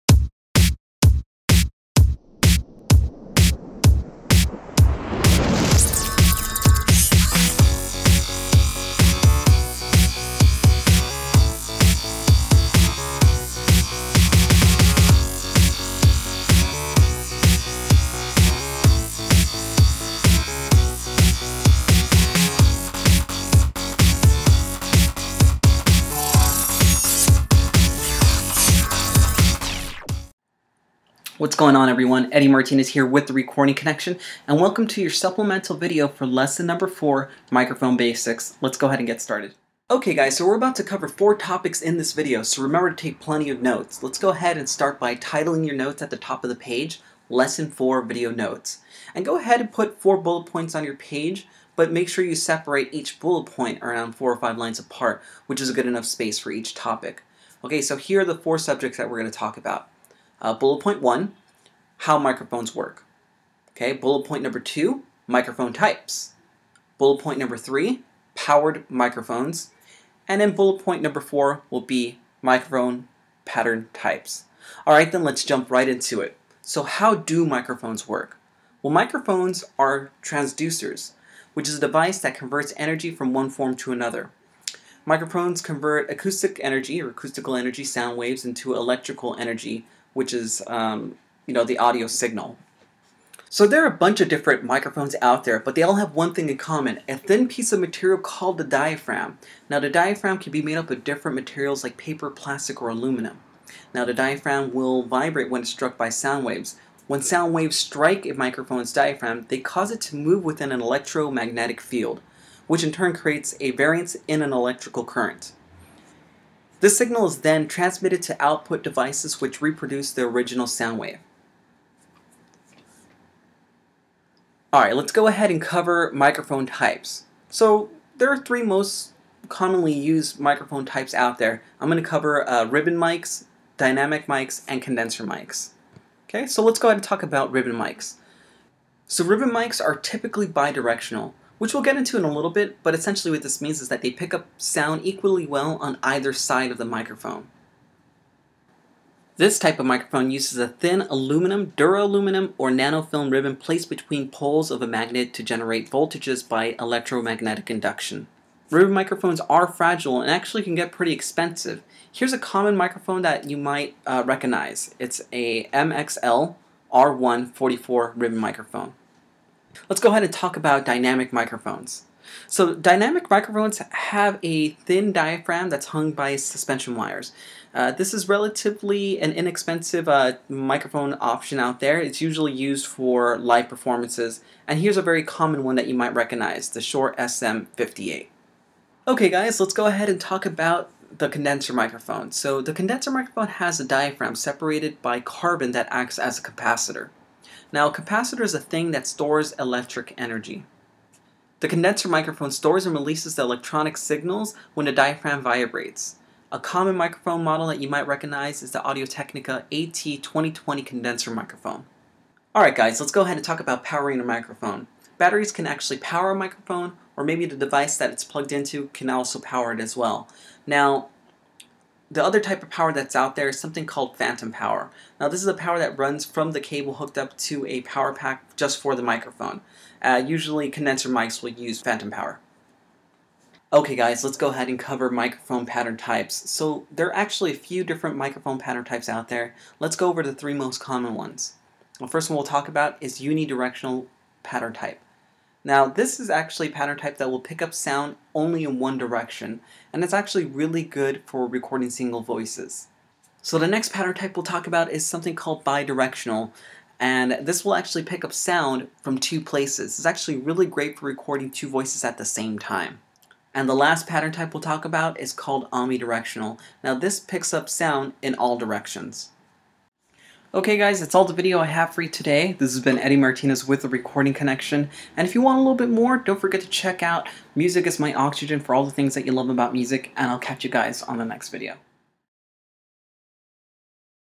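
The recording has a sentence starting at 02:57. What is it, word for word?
Uh, this is relatively an inexpensive uh, microphone option out there.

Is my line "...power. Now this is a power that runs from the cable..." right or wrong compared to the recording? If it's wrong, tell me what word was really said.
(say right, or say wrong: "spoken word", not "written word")
right.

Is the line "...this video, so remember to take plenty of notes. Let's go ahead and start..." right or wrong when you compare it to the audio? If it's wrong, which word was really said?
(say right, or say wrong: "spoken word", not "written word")
right.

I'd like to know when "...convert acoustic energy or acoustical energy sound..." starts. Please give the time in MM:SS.
01:25.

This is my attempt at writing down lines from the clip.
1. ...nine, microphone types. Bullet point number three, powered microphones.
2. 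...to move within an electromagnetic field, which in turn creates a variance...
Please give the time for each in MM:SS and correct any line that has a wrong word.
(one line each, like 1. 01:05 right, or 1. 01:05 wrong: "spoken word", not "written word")
1. 01:04 wrong: "two", not "nine"
2. 01:50 right.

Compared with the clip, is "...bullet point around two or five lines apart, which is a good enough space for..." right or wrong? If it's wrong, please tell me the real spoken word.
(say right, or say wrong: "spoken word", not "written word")
wrong: "four", not "two".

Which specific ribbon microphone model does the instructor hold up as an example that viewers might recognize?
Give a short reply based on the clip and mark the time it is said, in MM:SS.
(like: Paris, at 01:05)
MXL R144, at 02:45.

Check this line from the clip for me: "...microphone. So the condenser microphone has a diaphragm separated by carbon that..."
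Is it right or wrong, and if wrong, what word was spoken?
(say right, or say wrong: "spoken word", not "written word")
right.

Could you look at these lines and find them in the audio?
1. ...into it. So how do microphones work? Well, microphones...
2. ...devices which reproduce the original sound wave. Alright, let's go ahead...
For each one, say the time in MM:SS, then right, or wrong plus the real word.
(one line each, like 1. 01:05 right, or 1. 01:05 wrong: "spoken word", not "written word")
1. 01:15 right
2. 01:58 right.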